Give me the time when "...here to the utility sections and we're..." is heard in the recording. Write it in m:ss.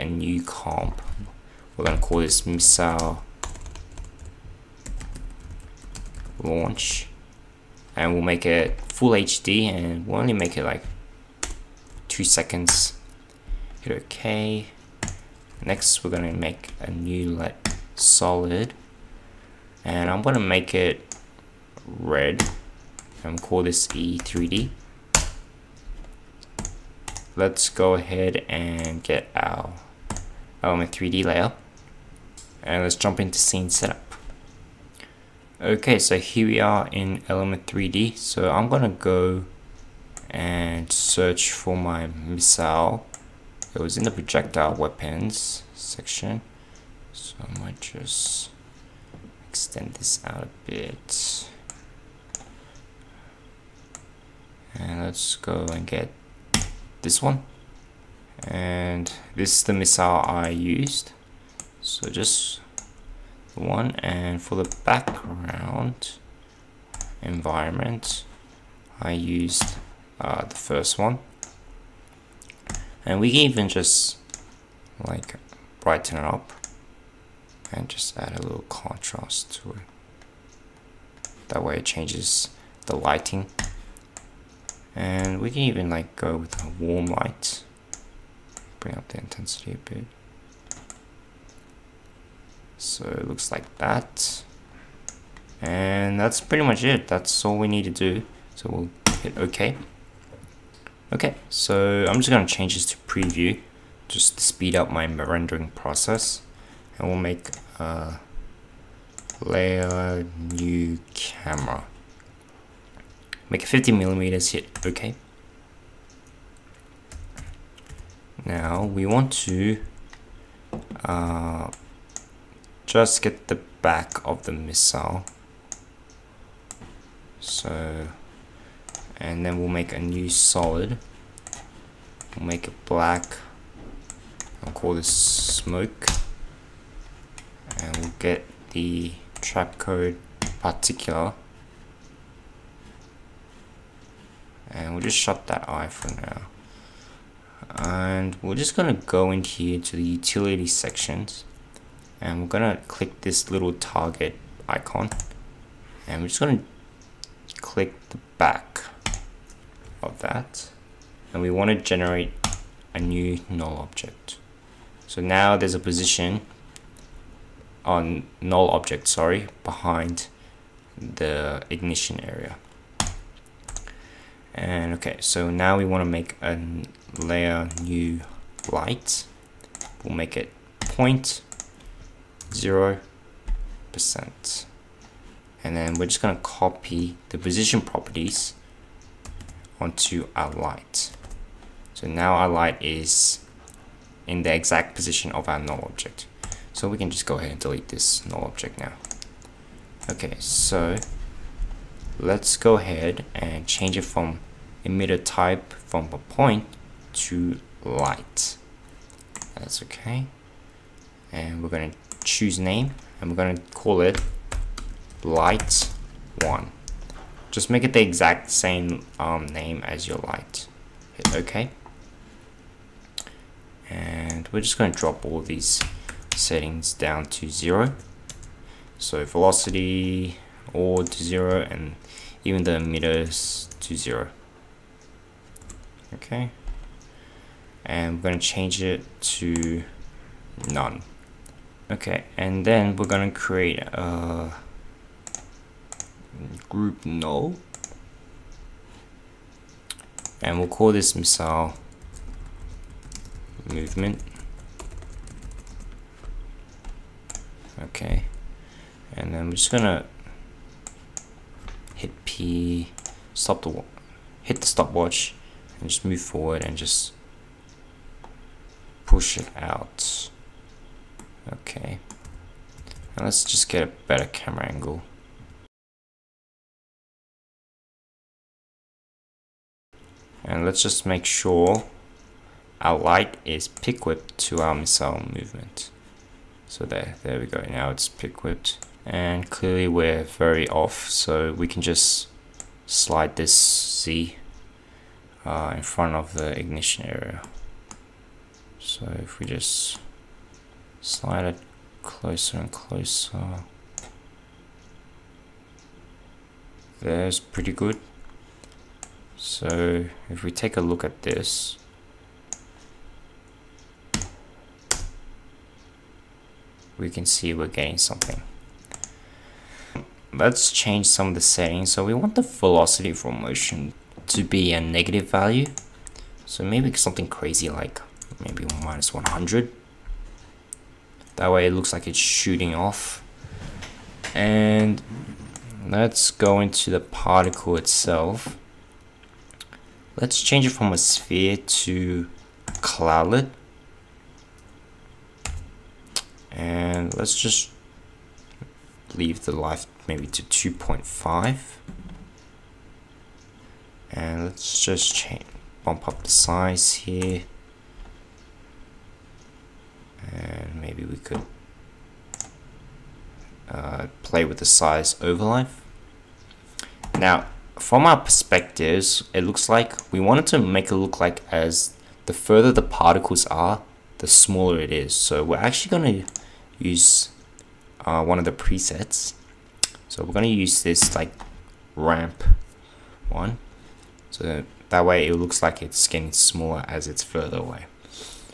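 2:29.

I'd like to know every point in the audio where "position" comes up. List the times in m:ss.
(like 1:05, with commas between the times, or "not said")
2:45, 3:07, 3:14.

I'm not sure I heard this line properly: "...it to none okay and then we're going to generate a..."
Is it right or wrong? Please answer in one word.
wrong.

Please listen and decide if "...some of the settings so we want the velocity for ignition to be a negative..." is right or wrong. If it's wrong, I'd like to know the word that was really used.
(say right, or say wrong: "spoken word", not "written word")
wrong: "motion", not "ignition".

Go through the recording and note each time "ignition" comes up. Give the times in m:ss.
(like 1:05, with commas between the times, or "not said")
2:51, 4:56.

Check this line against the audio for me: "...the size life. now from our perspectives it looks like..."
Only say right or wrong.
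right.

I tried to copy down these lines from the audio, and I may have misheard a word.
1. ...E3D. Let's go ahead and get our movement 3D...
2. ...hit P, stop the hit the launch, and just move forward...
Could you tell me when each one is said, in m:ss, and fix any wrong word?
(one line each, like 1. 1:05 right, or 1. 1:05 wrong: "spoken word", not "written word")
1. 0:23 wrong: "element", not "movement"
2. 4:21 wrong: "stopwatch", not "launch".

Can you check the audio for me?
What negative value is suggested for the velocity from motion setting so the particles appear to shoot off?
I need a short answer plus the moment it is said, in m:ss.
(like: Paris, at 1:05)
-100, at 5:28.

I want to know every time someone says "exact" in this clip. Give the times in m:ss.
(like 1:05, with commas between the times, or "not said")
3:14, 3:38.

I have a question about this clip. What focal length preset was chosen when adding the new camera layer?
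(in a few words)
50 millimeters.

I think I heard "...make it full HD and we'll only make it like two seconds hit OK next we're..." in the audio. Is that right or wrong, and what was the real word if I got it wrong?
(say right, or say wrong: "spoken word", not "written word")
right.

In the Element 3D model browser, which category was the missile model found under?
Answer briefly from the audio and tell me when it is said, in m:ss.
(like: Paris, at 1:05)
projectile weapons, at 0:44.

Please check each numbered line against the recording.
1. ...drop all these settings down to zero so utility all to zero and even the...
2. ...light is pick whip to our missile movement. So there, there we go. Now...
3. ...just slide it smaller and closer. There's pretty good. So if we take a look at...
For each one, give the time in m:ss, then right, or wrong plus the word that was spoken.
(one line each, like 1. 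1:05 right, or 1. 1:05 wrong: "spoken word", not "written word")
1. 3:44 wrong: "velocity", not "utility"
2. 4:42 right
3. 4:59 wrong: "closer", not "smaller".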